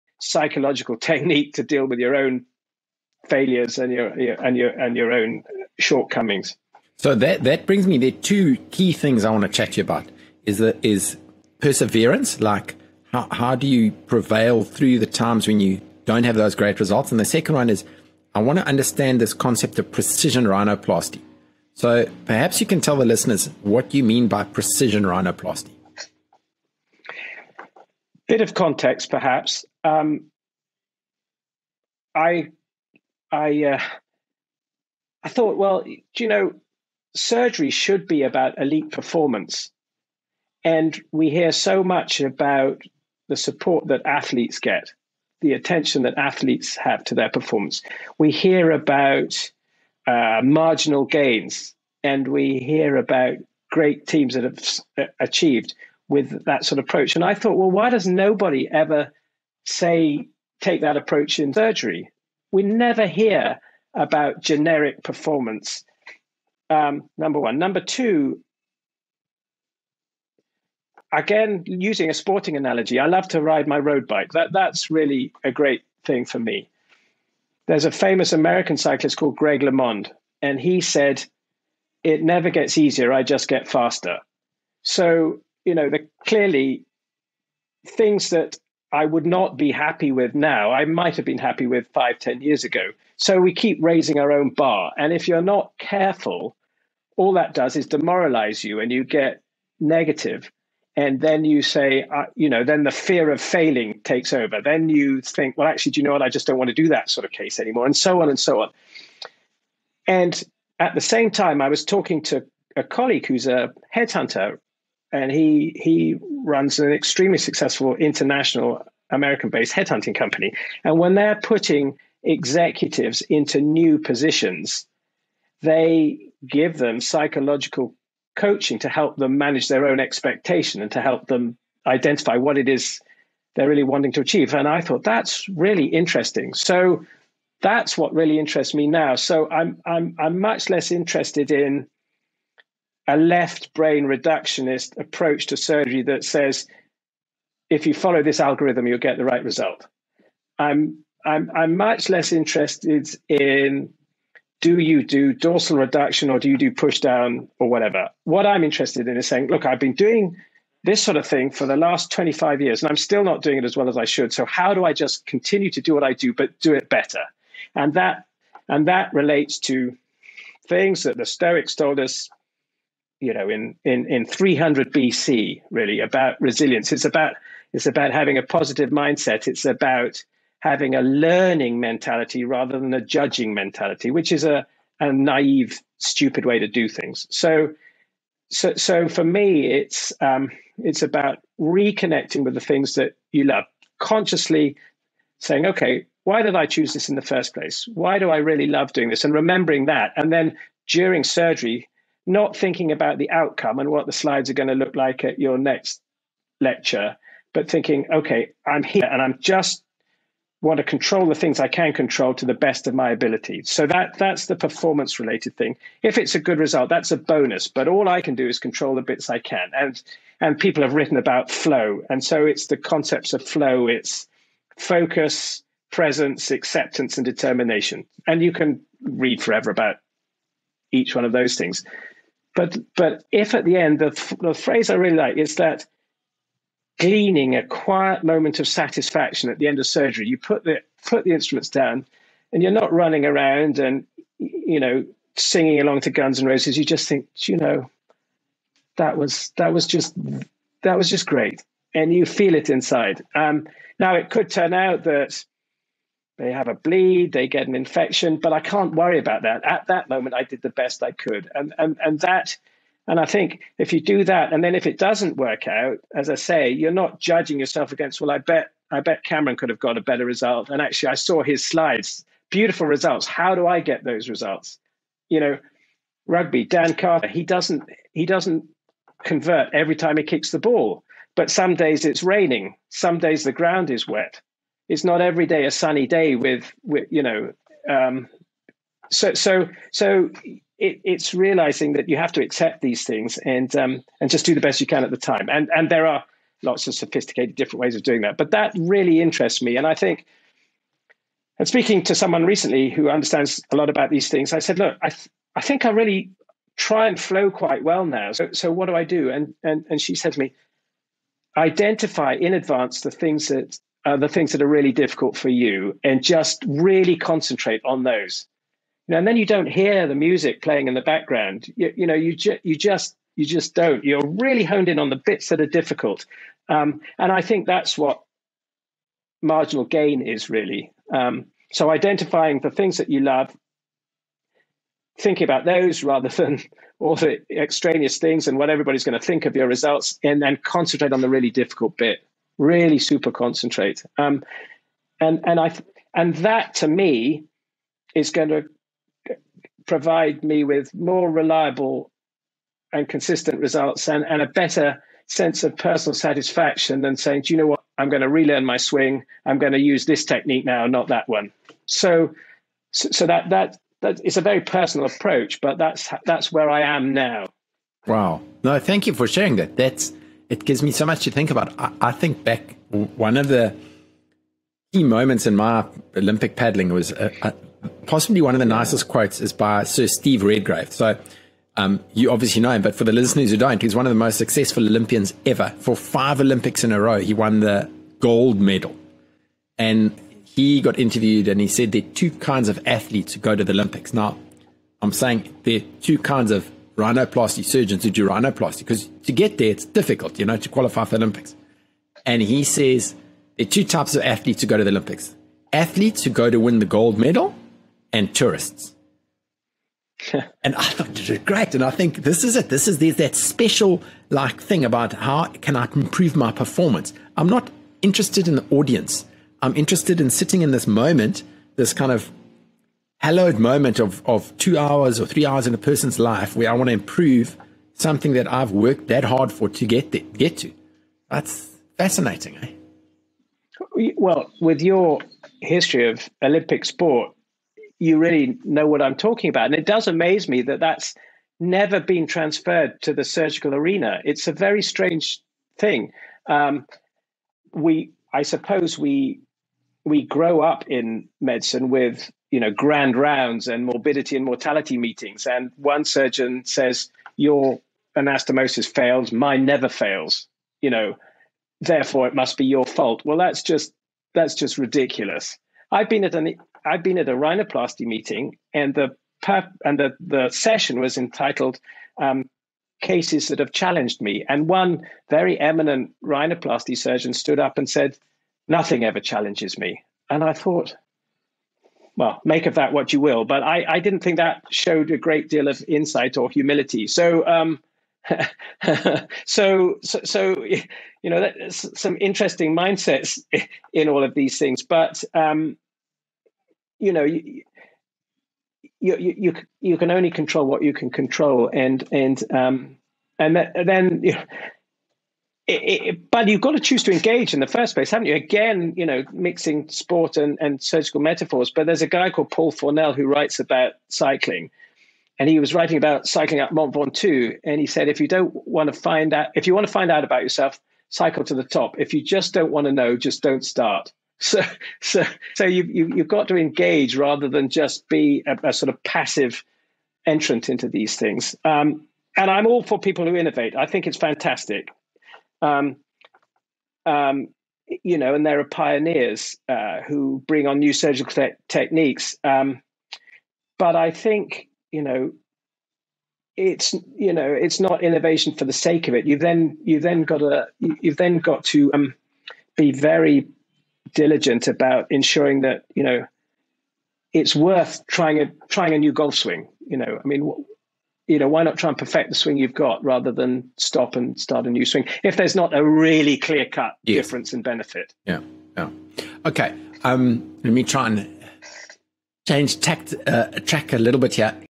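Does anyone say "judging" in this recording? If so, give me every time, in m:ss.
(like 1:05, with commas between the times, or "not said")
3:03, 4:27.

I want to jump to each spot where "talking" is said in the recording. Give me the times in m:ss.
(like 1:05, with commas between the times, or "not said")
1:51, 7:19.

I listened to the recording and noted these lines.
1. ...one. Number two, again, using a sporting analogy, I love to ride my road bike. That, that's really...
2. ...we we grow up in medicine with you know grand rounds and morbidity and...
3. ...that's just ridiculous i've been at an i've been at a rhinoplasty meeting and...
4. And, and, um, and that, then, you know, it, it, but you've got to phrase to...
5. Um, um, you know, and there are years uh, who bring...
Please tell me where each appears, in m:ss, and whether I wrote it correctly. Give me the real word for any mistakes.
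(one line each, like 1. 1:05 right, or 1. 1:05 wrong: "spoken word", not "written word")
1. 1:07 right
2. 7:28 right
3. 7:44 right
4. 8:21 wrong: "choose", not "phrase"
5. 8:55 wrong: "pioneers", not "years".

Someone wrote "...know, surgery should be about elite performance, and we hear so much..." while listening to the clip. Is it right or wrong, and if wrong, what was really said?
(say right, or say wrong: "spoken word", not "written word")
right.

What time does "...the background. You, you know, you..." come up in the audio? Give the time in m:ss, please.
5:20.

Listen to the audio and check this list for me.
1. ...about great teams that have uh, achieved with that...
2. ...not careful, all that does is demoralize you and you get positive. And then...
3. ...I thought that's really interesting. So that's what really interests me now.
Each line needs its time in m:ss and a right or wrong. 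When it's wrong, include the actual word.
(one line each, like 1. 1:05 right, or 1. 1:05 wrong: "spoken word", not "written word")
1. 0:52 right
2. 1:35 wrong: "negative", not "positive"
3. 2:14 right.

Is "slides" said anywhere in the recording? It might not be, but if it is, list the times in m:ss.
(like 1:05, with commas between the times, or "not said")
3:24, 4:31.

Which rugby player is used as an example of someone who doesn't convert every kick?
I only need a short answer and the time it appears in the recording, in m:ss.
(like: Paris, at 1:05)
Dan Carter, at 4:36.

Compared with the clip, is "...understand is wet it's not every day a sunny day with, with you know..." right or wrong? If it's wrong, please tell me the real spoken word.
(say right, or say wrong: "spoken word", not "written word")
wrong: "ground", not "understand".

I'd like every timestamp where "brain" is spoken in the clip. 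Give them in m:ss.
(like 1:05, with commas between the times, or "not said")
2:23.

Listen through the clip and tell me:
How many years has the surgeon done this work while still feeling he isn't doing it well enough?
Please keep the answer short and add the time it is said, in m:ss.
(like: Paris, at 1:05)
25, at 2:42.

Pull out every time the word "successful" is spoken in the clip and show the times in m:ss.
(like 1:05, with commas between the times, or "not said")
1:57, 6:24.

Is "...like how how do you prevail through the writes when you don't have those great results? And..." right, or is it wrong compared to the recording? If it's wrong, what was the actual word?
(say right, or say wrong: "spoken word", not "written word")
wrong: "times", not "writes".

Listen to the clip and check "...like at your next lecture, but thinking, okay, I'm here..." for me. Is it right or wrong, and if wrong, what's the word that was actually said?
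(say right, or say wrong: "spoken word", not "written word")
right.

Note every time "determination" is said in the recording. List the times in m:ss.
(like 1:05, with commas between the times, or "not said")
3:47.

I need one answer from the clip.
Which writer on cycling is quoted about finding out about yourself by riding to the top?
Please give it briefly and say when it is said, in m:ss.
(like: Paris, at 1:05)
Paul Fournel, at 8:32.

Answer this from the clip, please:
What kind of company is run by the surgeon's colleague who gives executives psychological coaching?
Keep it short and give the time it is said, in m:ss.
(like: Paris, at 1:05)
headhunting company, at 1:59.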